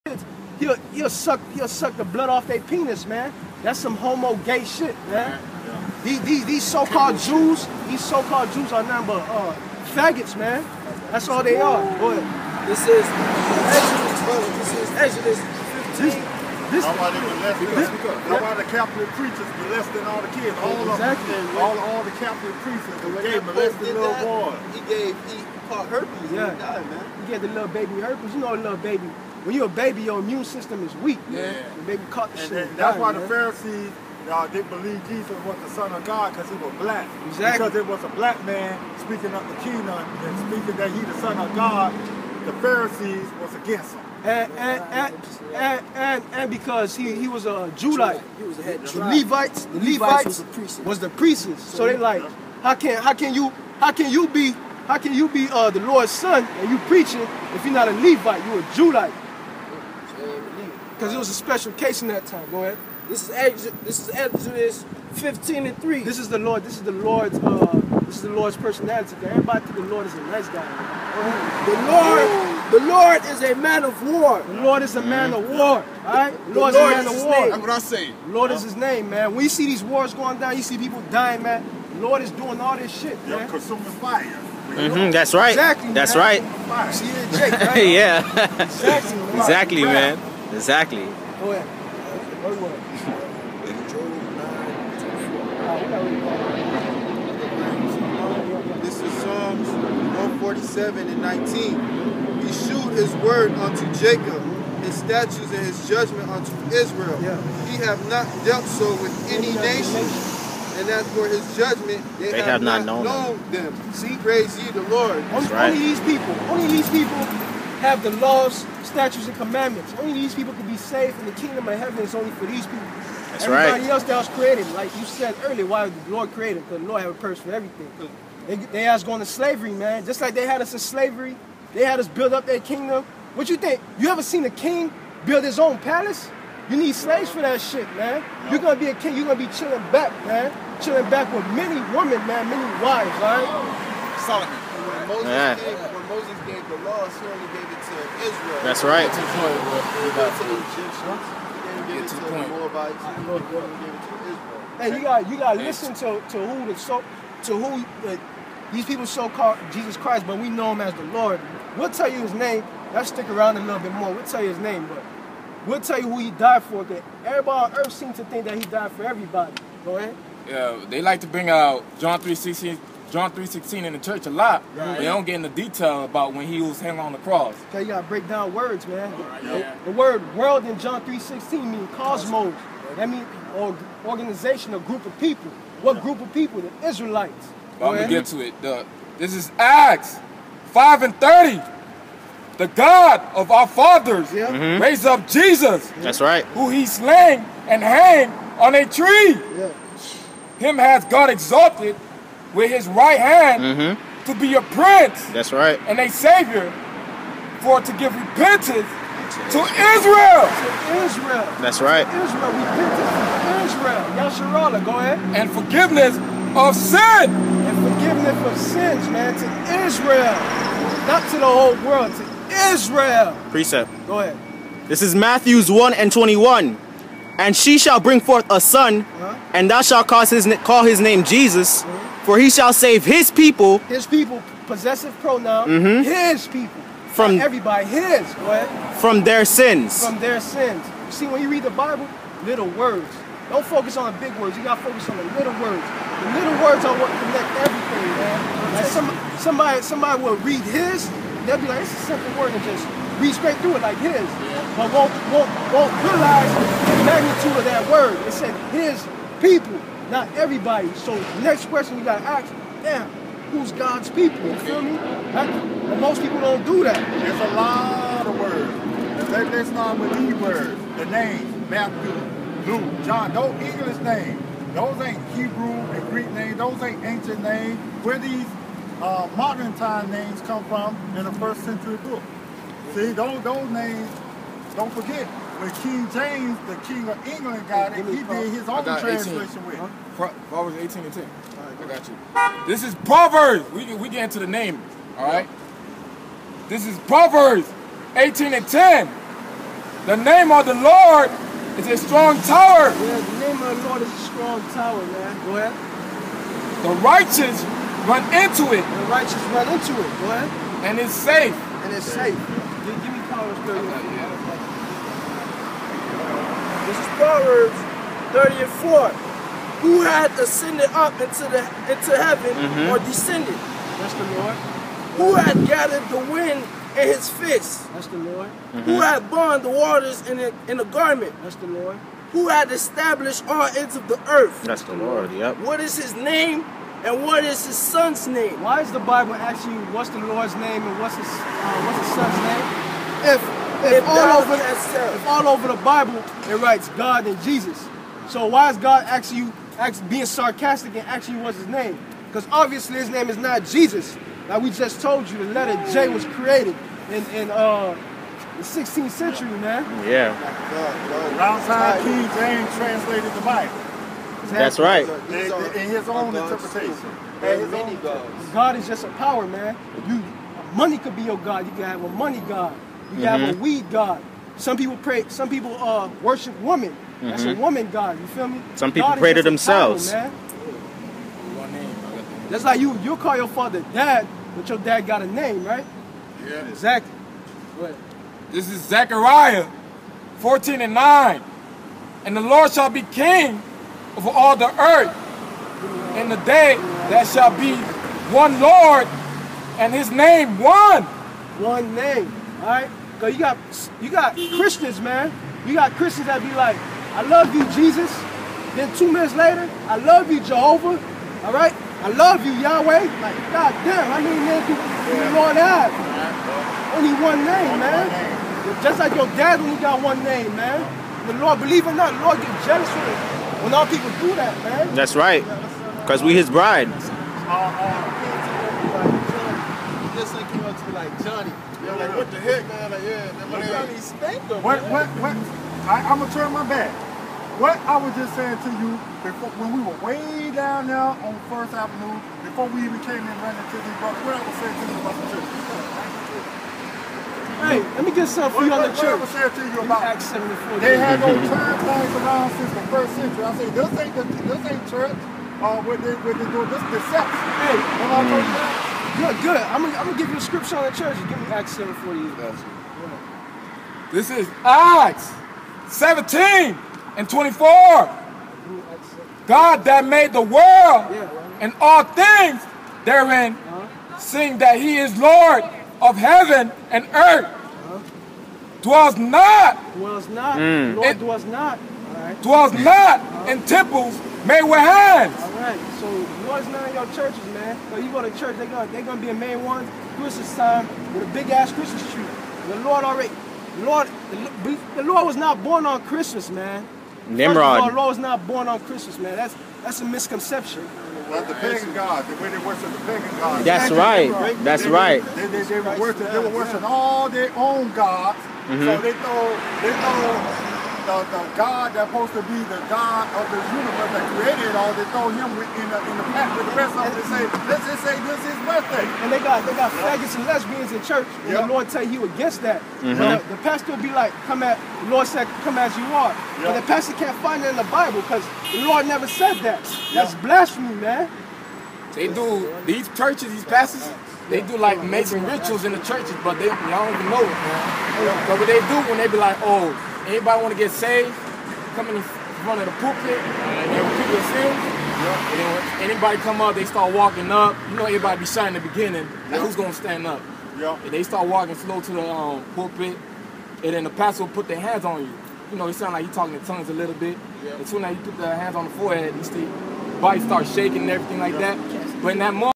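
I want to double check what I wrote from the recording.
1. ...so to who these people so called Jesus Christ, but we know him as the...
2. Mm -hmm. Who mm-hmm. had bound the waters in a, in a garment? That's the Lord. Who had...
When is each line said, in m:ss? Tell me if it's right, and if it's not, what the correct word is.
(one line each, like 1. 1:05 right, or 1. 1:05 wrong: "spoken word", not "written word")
1. 2:36 right
2. 5:28 right.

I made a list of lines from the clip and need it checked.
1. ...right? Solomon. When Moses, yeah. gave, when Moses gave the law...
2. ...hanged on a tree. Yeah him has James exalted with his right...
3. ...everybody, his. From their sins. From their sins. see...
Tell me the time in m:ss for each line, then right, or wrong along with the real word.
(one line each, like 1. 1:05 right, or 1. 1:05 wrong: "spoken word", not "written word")
1. 2:23 right
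2. 3:17 wrong: "God", not "James"
3. 3:57 right.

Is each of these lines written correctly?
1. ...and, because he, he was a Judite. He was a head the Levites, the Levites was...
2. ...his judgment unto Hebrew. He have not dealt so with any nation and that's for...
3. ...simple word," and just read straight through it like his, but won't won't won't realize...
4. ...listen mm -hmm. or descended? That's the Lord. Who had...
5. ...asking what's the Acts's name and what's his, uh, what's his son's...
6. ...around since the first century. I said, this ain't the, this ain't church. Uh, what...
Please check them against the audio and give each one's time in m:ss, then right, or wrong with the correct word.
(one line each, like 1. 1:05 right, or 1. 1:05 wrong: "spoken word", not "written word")
1. 0:46 right
2. 1:45 wrong: "Israel", not "Hebrew"
3. 4:12 right
4. 5:22 wrong: "heaven", not "listen"
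5. 5:39 wrong: "Lord", not "Acts"
6. 7:32 right.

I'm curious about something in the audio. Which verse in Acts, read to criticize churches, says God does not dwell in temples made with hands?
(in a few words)
Acts 17:24.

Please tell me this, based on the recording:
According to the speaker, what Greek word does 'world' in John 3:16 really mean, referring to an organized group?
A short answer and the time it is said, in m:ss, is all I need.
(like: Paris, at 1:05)
cosmos, at 3:01.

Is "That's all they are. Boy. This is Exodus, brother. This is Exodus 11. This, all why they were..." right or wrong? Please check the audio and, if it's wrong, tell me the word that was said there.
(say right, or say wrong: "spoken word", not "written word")
wrong: "15", not "11".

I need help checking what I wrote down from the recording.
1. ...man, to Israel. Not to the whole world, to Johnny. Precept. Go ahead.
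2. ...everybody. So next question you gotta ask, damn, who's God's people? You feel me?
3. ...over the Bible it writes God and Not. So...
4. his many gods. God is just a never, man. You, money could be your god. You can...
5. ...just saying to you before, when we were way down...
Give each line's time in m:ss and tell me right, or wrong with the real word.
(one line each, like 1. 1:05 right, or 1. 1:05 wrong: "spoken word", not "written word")
1. 3:39 wrong: "Israel", not "Johnny"
2. 4:20 right
3. 5:45 wrong: "Jesus", not "Not"
4. 6:07 wrong: "power", not "never"
5. 7:18 right.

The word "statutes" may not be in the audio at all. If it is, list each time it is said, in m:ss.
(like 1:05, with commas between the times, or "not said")
1:44, 1:58.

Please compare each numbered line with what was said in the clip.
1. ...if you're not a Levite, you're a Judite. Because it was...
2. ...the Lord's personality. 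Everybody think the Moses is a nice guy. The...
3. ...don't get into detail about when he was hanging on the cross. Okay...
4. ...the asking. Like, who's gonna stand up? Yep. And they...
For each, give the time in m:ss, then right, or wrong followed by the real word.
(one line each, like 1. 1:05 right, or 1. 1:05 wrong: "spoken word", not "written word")
1. 0:57 right
2. 1:08 wrong: "Lord", not "Moses"
3. 2:55 right
4. 9:08 wrong: "beginning", not "asking".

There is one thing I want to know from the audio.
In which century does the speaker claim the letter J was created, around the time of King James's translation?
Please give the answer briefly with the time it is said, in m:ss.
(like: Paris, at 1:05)
16th century, at 5:58.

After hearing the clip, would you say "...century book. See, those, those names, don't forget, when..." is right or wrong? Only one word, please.
right.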